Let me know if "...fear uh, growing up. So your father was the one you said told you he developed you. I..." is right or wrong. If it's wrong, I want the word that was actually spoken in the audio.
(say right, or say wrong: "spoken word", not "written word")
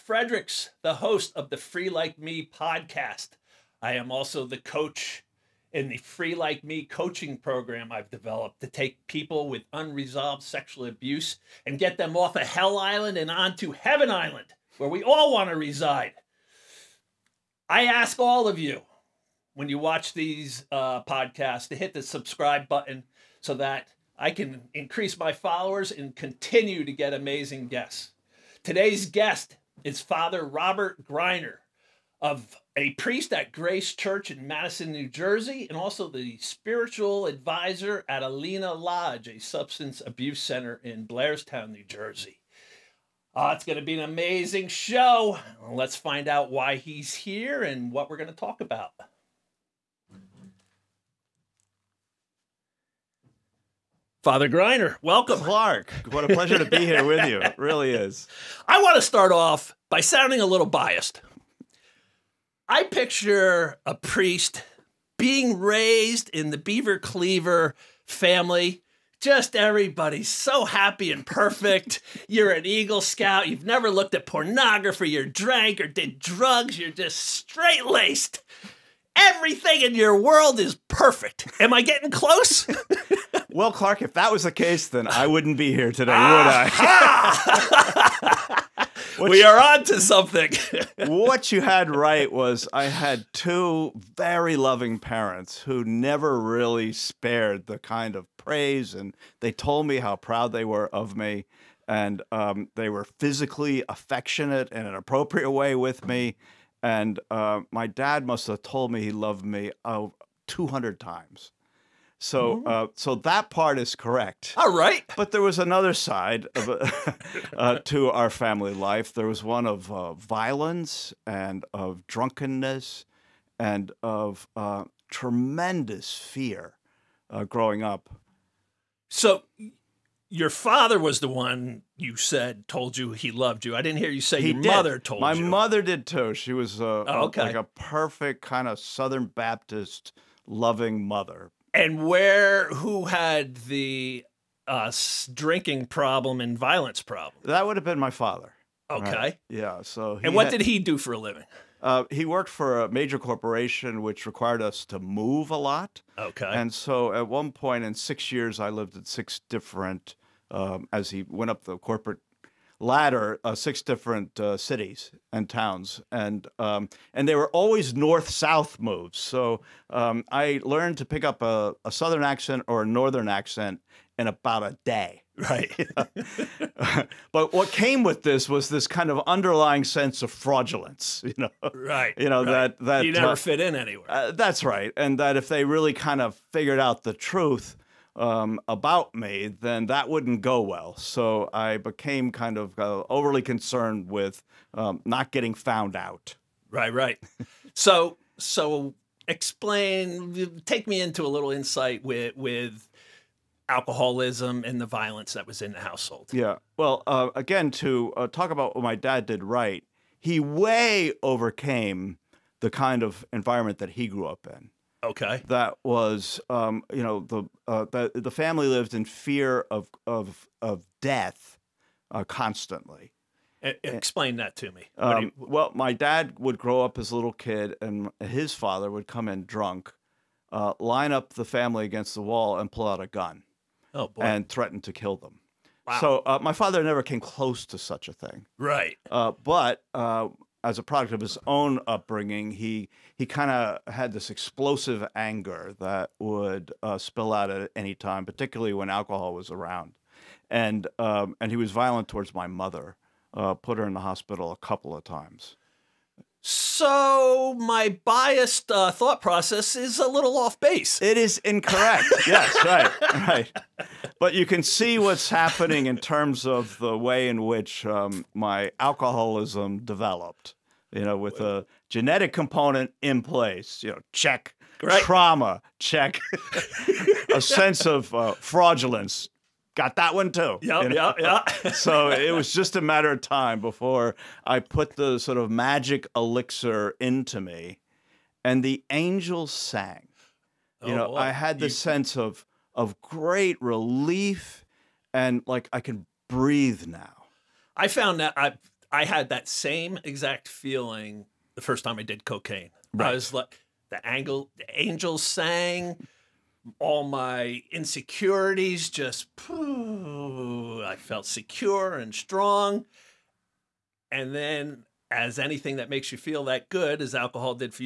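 wrong: "loved", not "developed".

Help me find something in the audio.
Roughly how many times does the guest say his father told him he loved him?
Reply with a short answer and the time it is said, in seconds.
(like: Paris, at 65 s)
200, at 110 s.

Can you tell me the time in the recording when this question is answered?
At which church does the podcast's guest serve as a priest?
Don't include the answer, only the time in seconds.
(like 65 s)
33 s.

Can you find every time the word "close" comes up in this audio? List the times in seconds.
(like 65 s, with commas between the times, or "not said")
82 s, 237 s.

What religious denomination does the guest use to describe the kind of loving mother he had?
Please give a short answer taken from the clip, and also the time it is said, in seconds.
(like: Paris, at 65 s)
Southern Baptist, at 138 s.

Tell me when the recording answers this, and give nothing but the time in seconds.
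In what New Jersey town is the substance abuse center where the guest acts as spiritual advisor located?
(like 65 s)
41 s.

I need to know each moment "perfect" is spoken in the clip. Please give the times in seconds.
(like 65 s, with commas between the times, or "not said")
71 s, 80 s, 137 s.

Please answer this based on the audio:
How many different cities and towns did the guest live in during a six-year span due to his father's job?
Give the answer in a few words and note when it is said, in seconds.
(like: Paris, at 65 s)
6, at 163 s.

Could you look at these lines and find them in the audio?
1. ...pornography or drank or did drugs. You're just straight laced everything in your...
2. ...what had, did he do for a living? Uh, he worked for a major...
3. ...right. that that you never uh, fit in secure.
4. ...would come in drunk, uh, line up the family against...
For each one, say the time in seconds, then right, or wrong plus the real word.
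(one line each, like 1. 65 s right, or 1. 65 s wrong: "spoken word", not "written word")
1. 74 s right
2. 150 s right
3. 182 s wrong: "anywhere", not "secure"
4. 228 s right.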